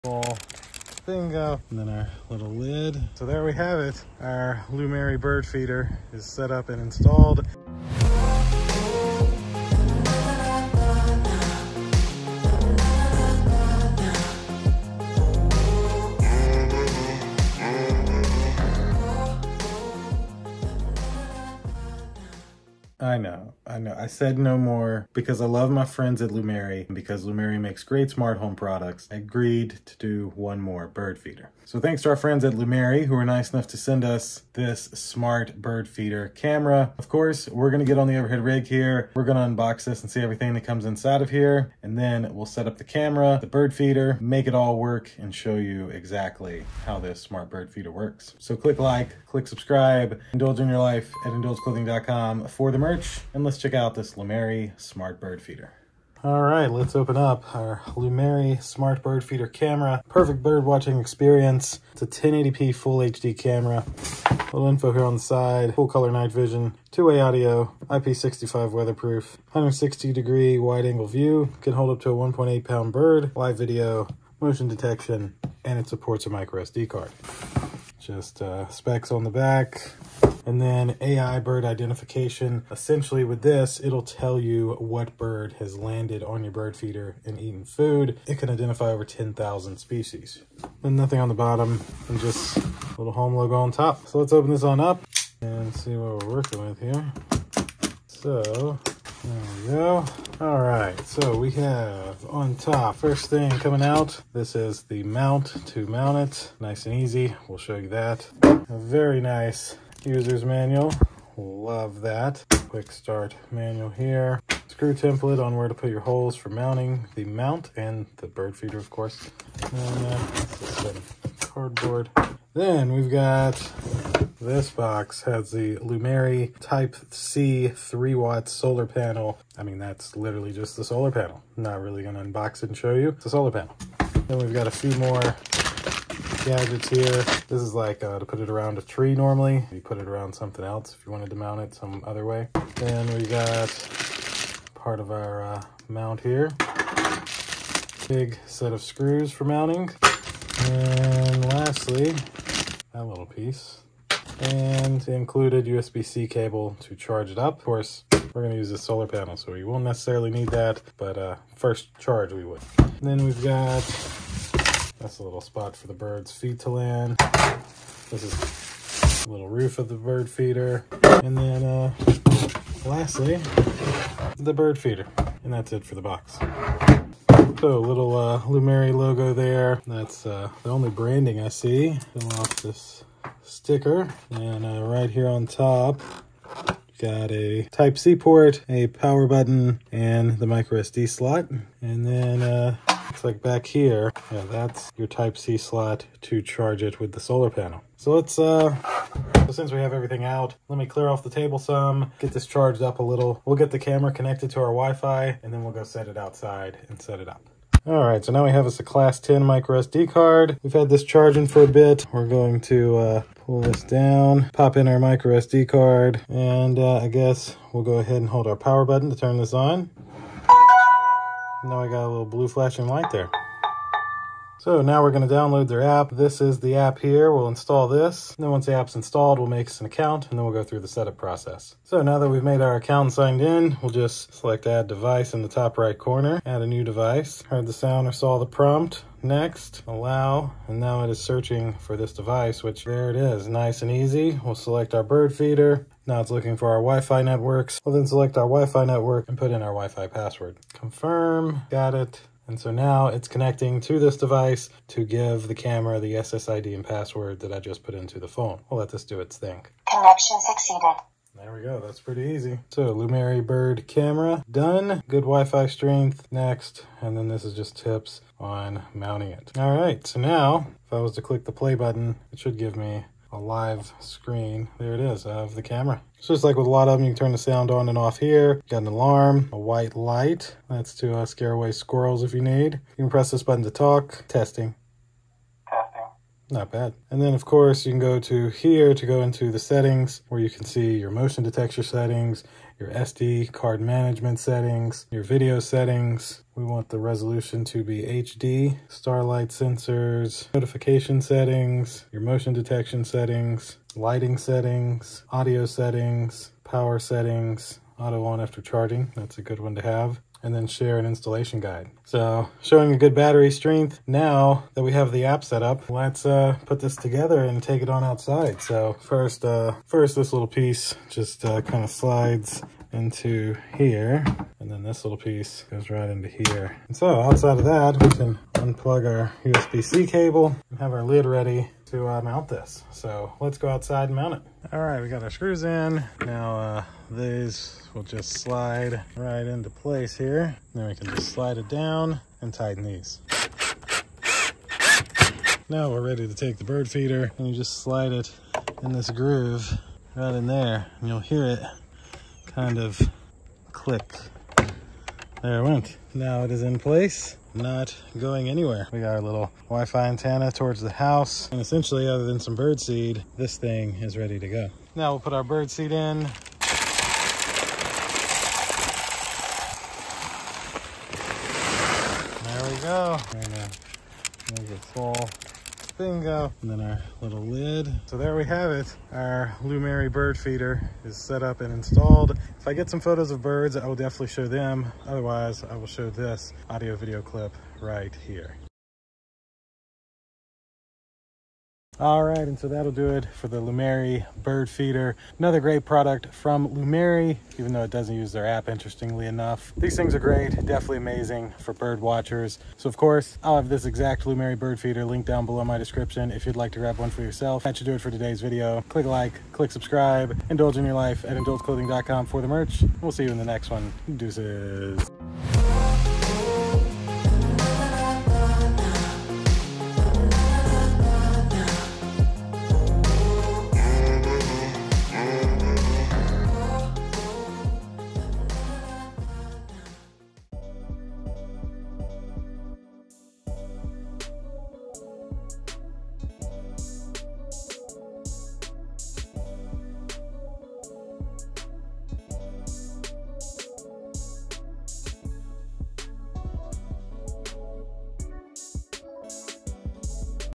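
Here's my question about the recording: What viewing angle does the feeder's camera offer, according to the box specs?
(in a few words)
160 degrees.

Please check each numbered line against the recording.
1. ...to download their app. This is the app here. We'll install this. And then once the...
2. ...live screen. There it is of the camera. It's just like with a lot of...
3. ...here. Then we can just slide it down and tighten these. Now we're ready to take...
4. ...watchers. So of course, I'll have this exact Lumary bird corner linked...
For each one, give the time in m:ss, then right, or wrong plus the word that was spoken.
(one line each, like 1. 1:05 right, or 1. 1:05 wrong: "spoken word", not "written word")
1. 3:45 right
2. 4:33 right
3. 5:40 right
4. 6:42 wrong: "feeder", not "corner".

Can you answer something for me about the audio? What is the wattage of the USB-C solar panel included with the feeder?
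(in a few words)
3 watt.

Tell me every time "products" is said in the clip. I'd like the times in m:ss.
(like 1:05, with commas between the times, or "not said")
0:28, 6:35.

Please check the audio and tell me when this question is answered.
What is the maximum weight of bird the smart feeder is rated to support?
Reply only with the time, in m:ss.
1:12.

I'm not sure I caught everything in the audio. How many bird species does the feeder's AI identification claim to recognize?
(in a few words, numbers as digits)
10,000.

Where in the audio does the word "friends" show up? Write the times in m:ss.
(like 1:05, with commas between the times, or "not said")
0:25, 0:32.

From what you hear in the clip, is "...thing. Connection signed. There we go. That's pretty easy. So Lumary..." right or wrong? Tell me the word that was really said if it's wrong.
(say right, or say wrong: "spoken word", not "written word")
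wrong: "succeeded", not "signed".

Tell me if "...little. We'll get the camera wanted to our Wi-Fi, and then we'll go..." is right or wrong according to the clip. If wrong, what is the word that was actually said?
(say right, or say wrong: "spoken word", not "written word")
wrong: "connected", not "wanted".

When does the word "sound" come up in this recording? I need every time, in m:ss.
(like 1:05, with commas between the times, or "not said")
3:57, 4:37.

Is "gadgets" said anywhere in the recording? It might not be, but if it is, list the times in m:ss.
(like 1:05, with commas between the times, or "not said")
2:16.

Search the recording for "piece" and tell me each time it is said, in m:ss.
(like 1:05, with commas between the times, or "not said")
2:33, 5:20, 5:25.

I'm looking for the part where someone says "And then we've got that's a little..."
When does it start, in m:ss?
2:42.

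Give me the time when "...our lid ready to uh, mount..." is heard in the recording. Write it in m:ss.
5:30.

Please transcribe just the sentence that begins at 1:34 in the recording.
So let's open this on up and see what we're working with here.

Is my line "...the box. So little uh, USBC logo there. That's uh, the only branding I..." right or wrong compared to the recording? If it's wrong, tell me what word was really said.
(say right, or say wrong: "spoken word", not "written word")
wrong: "Lumary", not "USBC".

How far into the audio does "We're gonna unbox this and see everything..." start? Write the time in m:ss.
0:39.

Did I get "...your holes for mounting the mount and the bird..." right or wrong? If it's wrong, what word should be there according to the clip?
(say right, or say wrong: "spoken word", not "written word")
right.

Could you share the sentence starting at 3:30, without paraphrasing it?
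We've had this charging for a bit.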